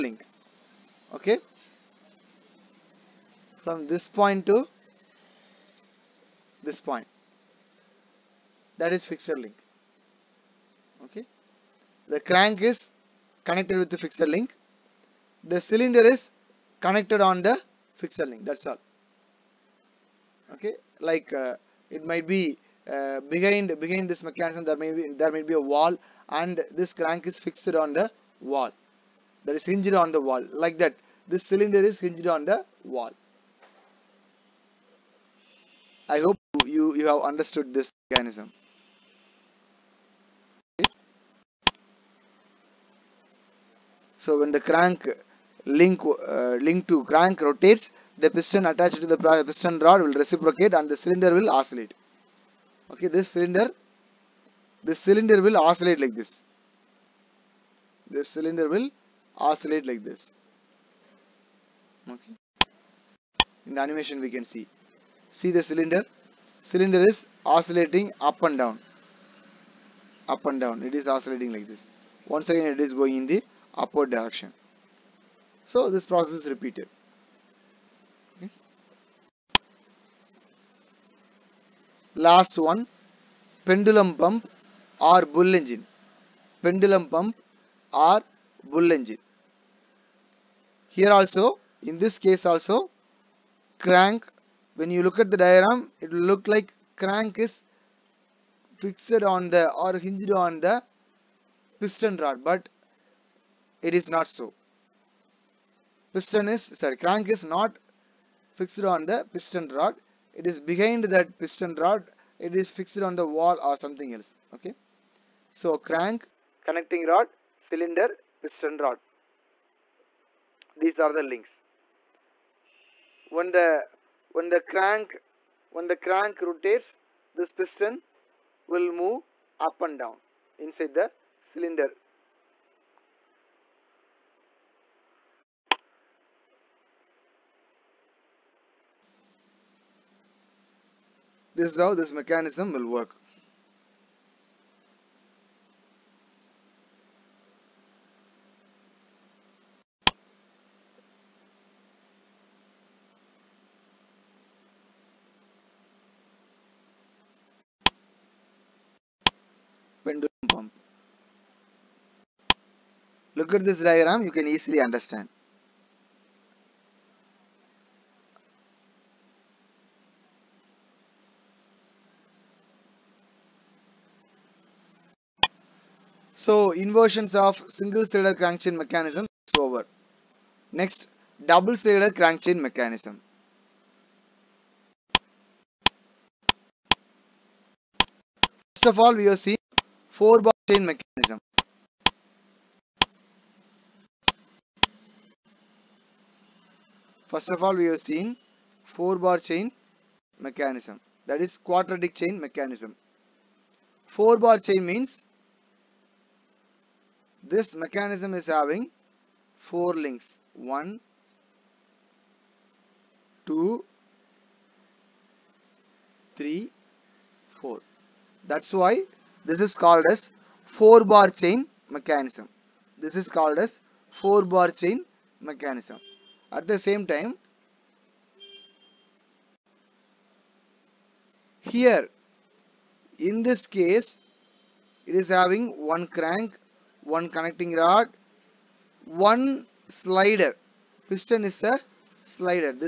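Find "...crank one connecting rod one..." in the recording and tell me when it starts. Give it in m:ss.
3:56.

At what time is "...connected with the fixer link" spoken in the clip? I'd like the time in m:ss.
0:13.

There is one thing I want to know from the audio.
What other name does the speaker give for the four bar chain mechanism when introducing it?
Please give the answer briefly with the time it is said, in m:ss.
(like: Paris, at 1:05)
quadratic chain mechanism, at 3:21.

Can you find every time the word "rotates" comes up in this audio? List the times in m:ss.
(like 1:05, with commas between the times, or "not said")
0:47, 2:06.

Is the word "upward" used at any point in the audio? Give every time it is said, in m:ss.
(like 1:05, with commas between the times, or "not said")
1:13.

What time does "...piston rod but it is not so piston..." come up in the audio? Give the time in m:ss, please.
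1:41.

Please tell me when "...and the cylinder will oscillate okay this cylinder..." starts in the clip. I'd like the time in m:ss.
0:50.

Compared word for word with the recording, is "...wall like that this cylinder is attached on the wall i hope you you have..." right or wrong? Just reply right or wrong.
wrong.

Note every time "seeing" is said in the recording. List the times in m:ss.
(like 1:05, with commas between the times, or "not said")
3:09, 3:18.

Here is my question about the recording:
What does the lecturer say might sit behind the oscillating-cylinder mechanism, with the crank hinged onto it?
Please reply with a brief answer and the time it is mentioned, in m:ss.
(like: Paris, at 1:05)
a wall, at 0:25.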